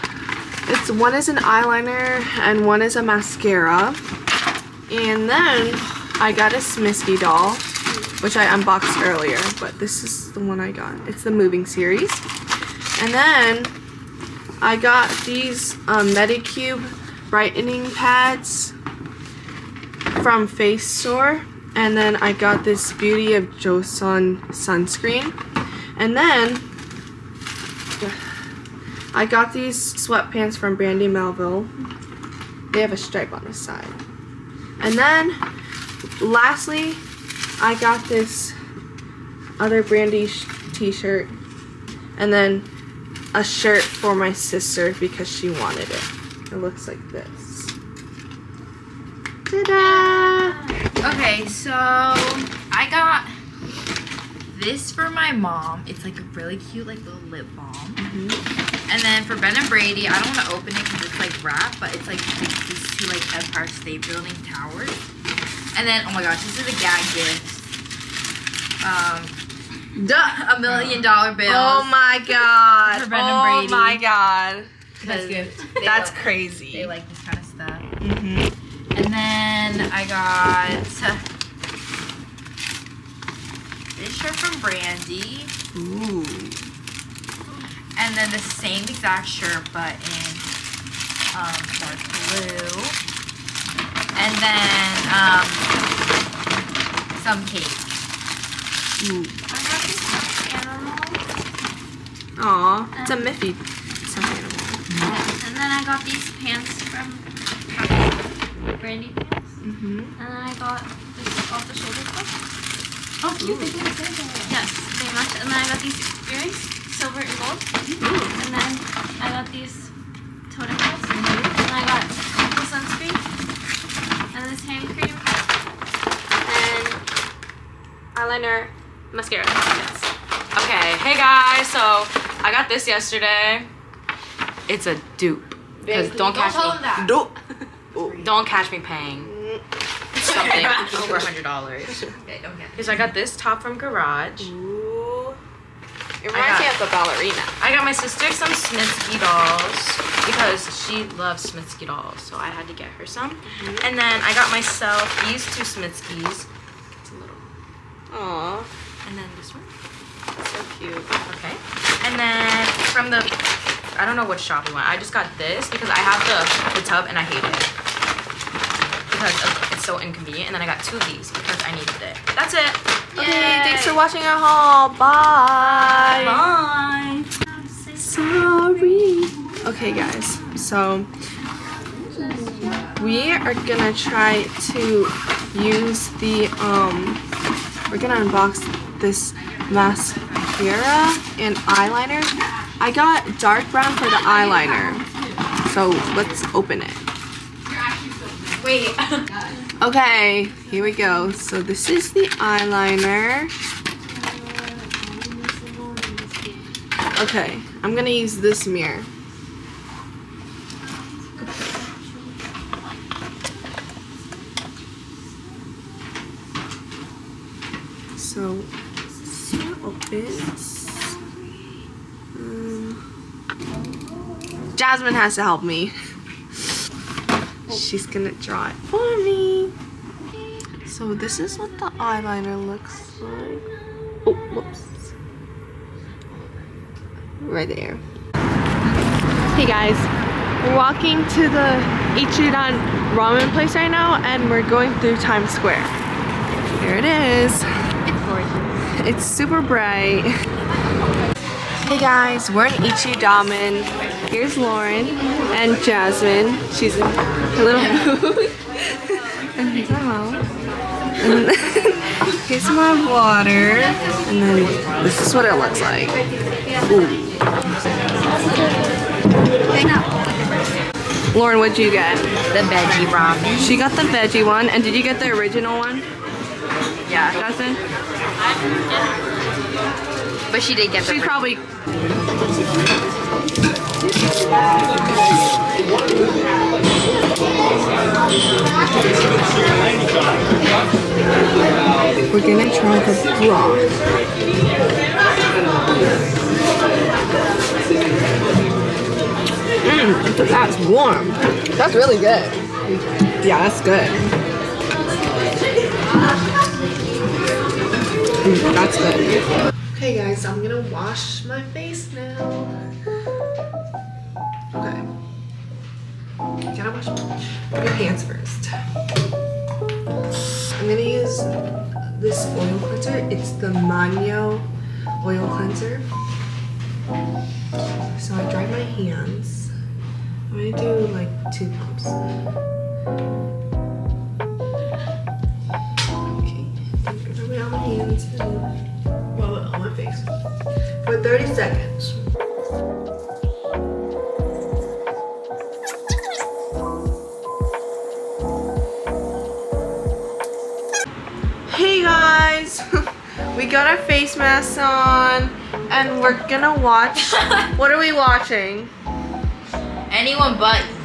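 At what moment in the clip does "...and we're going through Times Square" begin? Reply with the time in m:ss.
4:04.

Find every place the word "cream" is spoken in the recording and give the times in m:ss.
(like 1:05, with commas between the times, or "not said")
2:04.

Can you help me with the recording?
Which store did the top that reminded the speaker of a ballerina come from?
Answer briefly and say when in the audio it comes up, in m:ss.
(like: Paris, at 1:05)
Garage, at 2:23.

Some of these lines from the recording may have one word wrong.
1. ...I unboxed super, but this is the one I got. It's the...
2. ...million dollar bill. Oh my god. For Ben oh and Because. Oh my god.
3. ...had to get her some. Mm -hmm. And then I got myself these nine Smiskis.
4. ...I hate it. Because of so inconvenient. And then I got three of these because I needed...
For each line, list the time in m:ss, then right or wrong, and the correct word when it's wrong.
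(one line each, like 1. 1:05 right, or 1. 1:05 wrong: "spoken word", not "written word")
1. 0:08 wrong: "earlier", not "super"
2. 1:10 wrong: "Brady", not "Because"
3. 2:32 wrong: "two", not "nine"
4. 2:47 wrong: "two", not "three".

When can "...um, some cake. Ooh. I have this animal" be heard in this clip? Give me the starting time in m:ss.
1:35.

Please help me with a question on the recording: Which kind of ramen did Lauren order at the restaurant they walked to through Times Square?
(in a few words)
veggie ramen.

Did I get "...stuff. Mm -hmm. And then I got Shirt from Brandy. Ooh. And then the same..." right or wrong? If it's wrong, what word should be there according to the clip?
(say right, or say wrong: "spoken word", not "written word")
right.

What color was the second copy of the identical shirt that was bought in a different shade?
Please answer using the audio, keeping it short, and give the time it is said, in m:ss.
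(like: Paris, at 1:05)
dark blue, at 1:31.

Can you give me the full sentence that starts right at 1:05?
And then, oh my gosh, this is a gag gift.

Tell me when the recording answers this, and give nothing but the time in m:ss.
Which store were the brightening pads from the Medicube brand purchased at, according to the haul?
0:20.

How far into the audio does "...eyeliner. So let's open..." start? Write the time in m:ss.
3:14.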